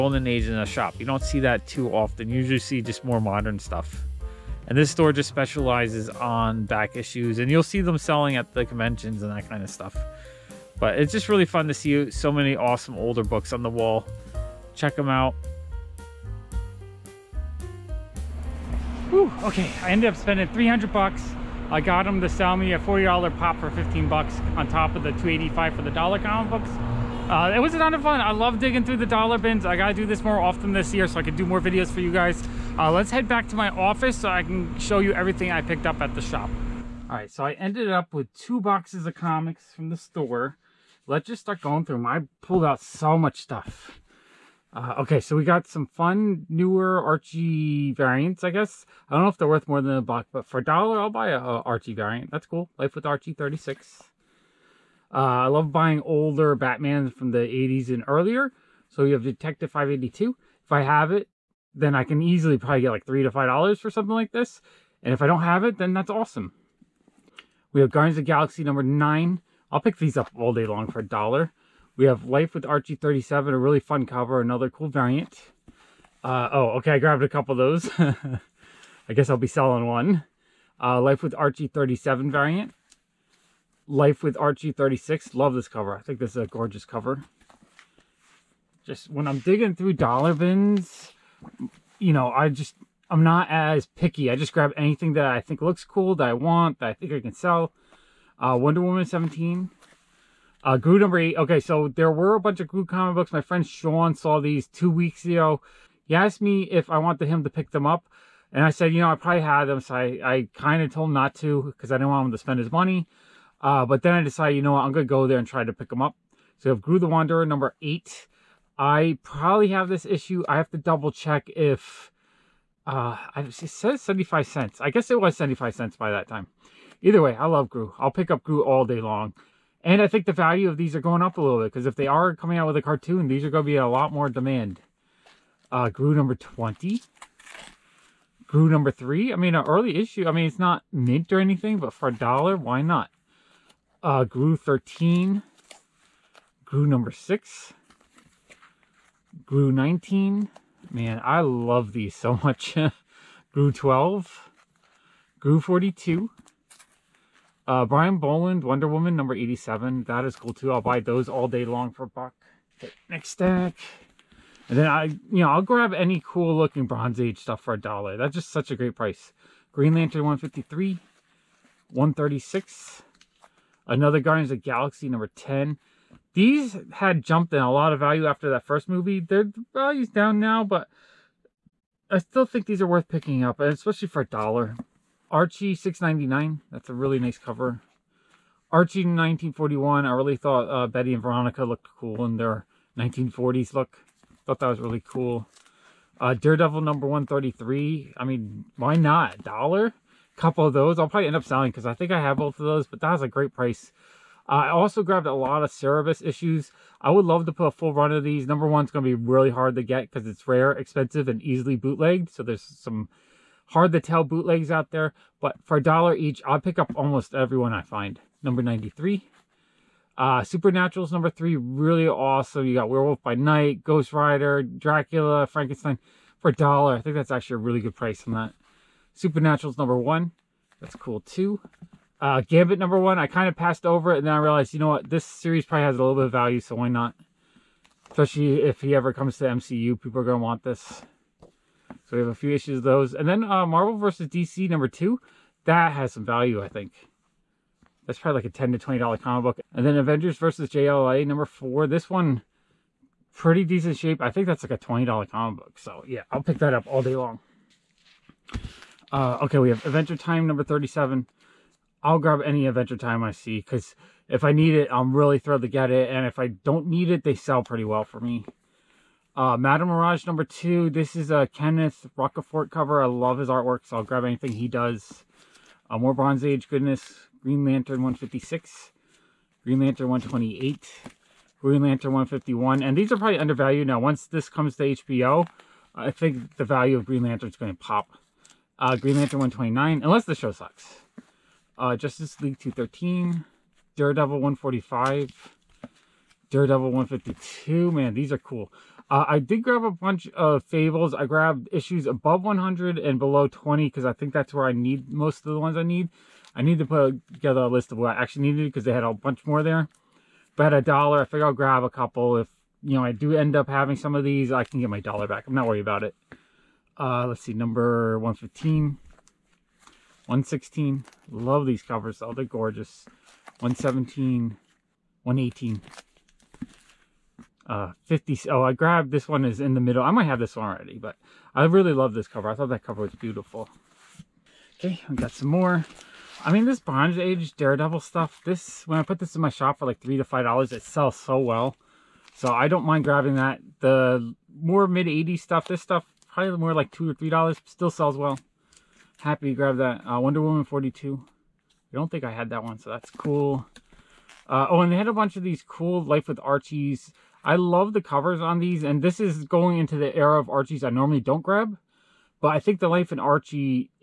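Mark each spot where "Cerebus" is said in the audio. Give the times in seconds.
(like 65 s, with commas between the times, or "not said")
205 s.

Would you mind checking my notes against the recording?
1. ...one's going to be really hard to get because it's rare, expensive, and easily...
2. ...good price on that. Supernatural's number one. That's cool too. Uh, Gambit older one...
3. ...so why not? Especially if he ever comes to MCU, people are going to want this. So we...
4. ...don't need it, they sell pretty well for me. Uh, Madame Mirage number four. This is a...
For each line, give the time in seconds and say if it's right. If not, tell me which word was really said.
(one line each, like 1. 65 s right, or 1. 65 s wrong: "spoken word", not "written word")
1. 208 s right
2. 227 s wrong: "number", not "older"
3. 236 s right
4. 266 s wrong: "two", not "four".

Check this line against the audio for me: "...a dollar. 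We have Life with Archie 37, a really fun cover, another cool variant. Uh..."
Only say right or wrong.
right.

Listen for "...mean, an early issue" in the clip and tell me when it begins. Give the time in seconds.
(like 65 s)
139 s.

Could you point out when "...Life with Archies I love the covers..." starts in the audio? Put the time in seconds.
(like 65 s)
356 s.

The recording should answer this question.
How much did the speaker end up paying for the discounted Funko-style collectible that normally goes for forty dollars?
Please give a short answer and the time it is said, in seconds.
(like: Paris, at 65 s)
$15, at 23 s.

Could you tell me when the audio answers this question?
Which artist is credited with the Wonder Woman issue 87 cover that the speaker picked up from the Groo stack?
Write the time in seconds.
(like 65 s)
157 s.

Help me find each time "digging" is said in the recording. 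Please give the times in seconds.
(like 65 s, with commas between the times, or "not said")
28 s, 89 s.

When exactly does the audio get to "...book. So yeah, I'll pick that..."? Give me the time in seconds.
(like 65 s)
255 s.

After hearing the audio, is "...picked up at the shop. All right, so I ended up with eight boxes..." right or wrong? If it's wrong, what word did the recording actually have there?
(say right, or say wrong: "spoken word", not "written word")
wrong: "two", not "eight".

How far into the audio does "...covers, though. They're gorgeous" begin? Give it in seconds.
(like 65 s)
321 s.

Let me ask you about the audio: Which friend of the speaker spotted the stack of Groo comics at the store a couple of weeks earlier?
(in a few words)
Sean.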